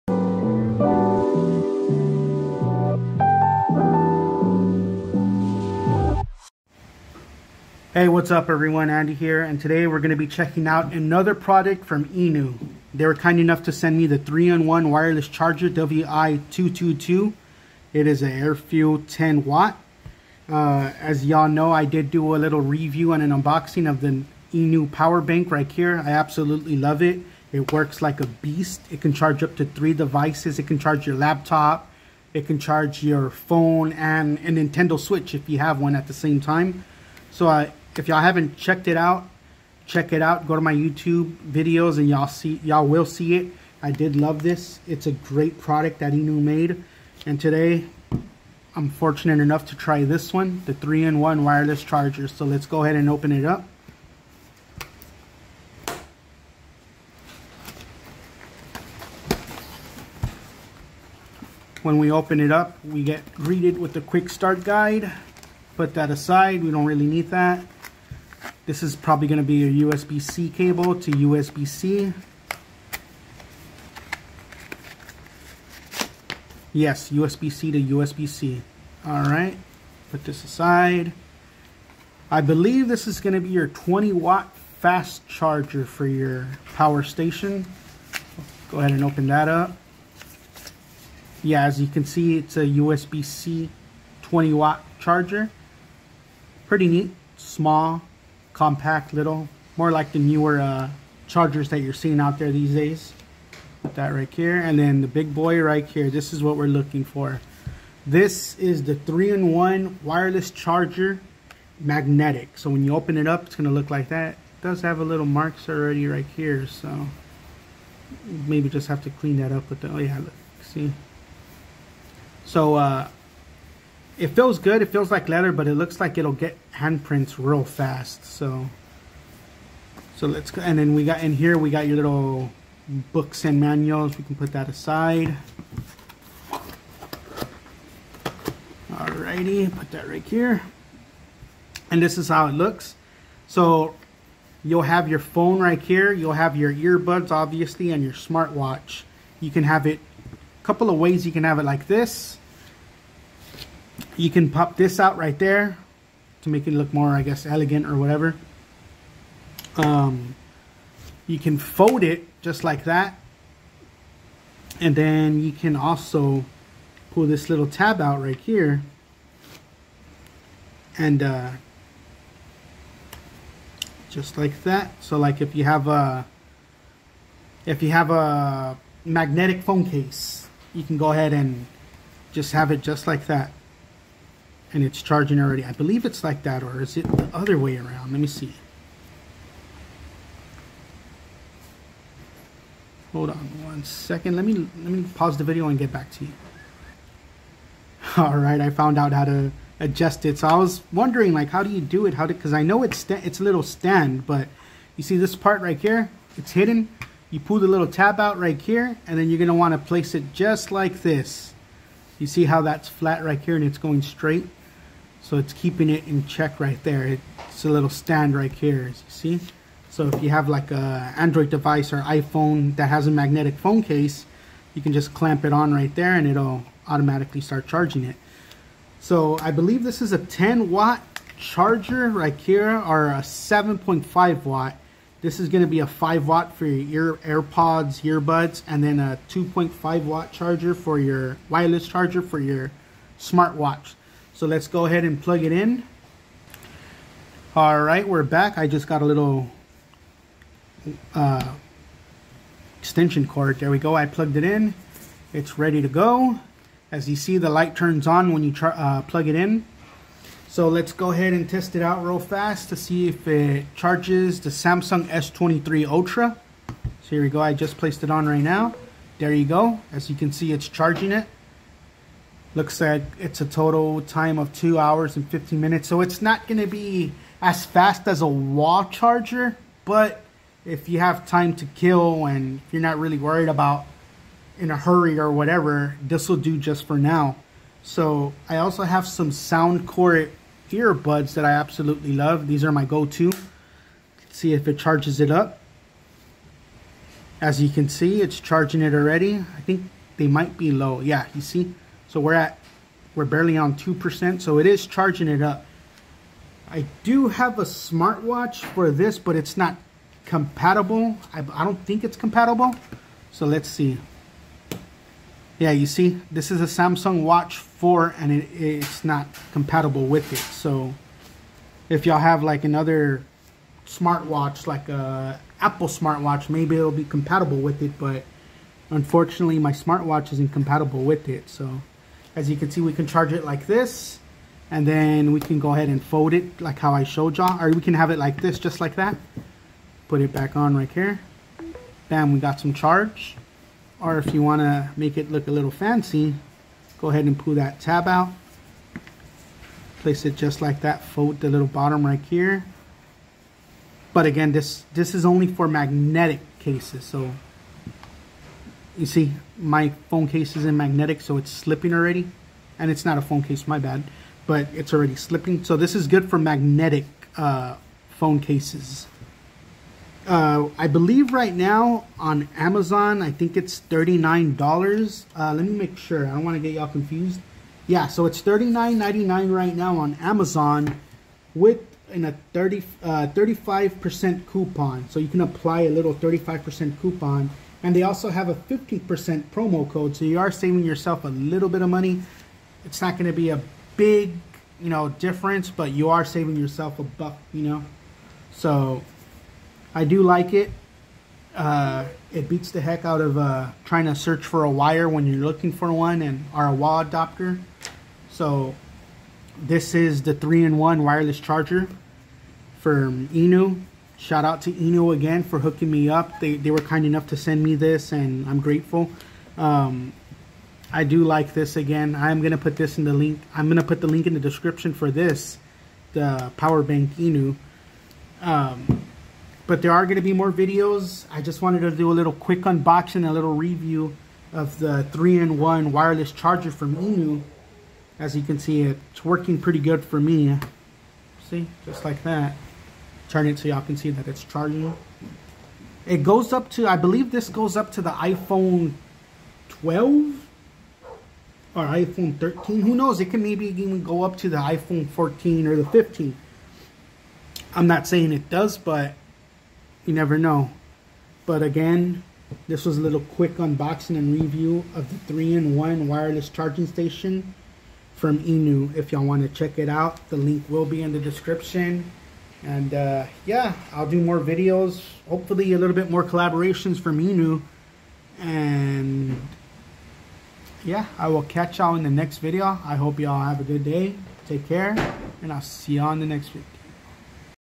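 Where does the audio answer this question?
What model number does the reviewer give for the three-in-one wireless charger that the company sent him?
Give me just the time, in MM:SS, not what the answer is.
00:15.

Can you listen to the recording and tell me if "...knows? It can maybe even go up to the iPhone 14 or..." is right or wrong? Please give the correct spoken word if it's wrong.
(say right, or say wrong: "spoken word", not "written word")
right.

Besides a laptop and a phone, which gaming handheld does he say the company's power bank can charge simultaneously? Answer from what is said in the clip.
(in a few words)
Nintendo Switch.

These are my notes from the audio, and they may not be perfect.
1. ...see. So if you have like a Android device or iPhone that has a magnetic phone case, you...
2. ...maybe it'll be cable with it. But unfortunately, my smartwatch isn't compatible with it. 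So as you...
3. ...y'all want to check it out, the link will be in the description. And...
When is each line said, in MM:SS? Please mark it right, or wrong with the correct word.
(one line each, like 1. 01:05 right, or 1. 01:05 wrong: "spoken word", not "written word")
1. 03:39 right
2. 05:26 wrong: "compatible", not "cable"
3. 07:49 right.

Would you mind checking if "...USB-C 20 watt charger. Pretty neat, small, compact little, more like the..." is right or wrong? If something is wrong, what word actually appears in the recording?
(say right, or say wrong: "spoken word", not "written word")
right.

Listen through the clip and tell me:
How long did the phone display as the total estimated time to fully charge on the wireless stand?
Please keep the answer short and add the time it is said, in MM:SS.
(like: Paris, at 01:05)
2 hours 15 minutes, at 04:34.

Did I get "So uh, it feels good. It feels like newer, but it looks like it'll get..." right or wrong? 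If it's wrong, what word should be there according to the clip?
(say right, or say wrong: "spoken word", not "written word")
wrong: "leather", not "newer".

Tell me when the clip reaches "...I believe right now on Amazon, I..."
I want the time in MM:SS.
06:10.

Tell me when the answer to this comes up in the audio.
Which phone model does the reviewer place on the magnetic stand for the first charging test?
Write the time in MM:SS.
04:24.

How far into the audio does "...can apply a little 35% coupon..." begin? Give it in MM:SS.
06:25.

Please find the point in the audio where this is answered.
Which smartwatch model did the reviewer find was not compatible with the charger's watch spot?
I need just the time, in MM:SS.
05:16.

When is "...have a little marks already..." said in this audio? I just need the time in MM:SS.
01:54.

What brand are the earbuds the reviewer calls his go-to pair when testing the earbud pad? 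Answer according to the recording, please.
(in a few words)
Soundcore.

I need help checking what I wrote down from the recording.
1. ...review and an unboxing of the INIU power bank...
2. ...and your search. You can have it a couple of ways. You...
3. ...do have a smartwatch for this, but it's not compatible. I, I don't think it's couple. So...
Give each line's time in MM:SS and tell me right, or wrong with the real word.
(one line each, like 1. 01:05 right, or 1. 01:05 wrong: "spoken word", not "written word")
1. 00:22 right
2. 02:27 wrong: "smartwatch", not "search"
3. 05:07 wrong: "compatible", not "couple".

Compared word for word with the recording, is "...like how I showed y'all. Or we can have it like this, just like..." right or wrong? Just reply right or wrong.
right.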